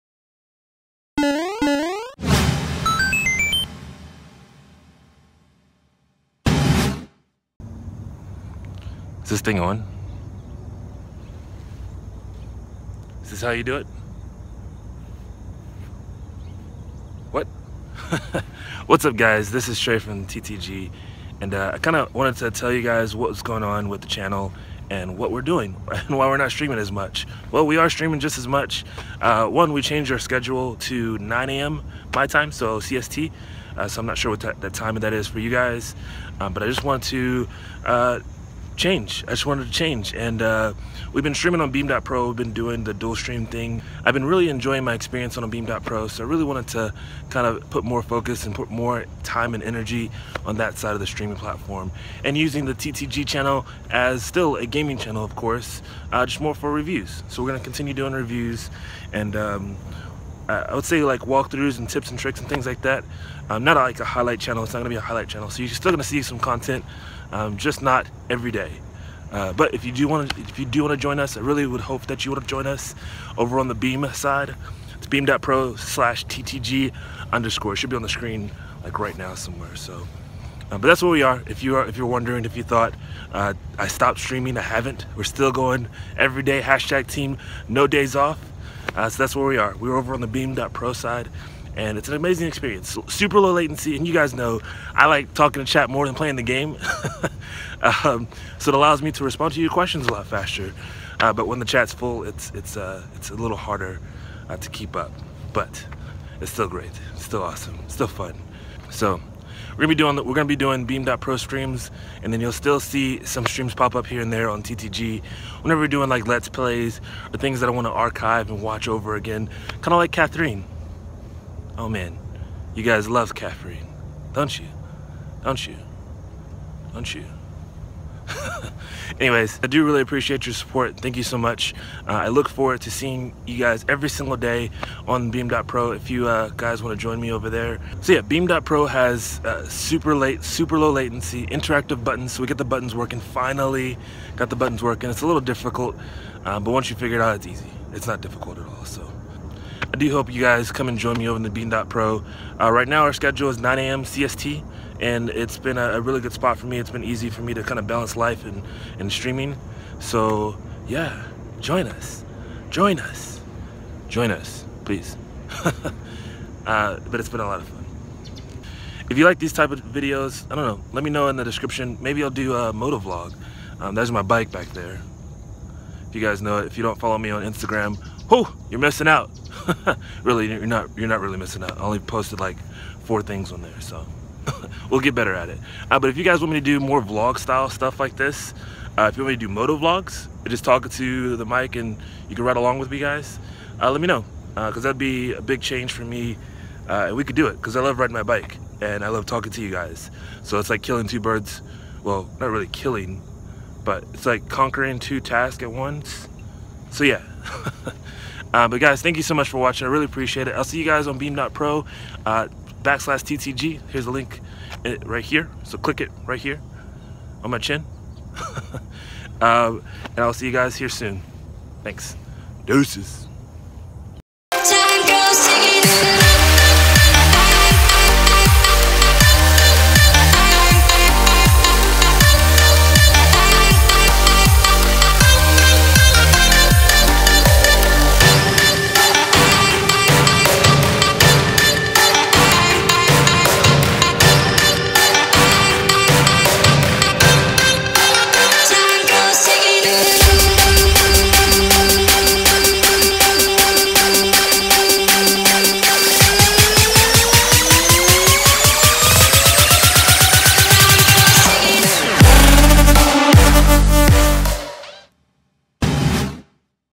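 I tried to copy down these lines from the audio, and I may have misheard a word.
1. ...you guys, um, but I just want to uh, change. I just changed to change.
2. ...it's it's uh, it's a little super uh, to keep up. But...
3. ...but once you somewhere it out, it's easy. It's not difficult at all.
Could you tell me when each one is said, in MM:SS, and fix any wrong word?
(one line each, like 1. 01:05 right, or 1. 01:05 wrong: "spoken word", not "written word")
1. 00:35 wrong: "wanted", not "changed"
2. 01:42 wrong: "harder", not "super"
3. 02:26 wrong: "figure", not "somewhere".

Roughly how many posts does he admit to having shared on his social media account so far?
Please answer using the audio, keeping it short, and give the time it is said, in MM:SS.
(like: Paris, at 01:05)
4, at 03:03.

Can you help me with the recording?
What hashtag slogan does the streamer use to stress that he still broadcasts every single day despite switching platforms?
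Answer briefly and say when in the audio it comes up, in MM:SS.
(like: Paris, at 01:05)
Team no days off, at 01:27.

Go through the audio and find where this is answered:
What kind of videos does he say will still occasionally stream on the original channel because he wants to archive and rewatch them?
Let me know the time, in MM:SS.
01:56.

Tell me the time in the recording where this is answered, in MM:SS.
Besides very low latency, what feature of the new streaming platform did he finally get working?
02:21.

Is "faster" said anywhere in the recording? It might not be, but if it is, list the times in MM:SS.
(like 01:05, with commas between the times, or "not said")
01:40.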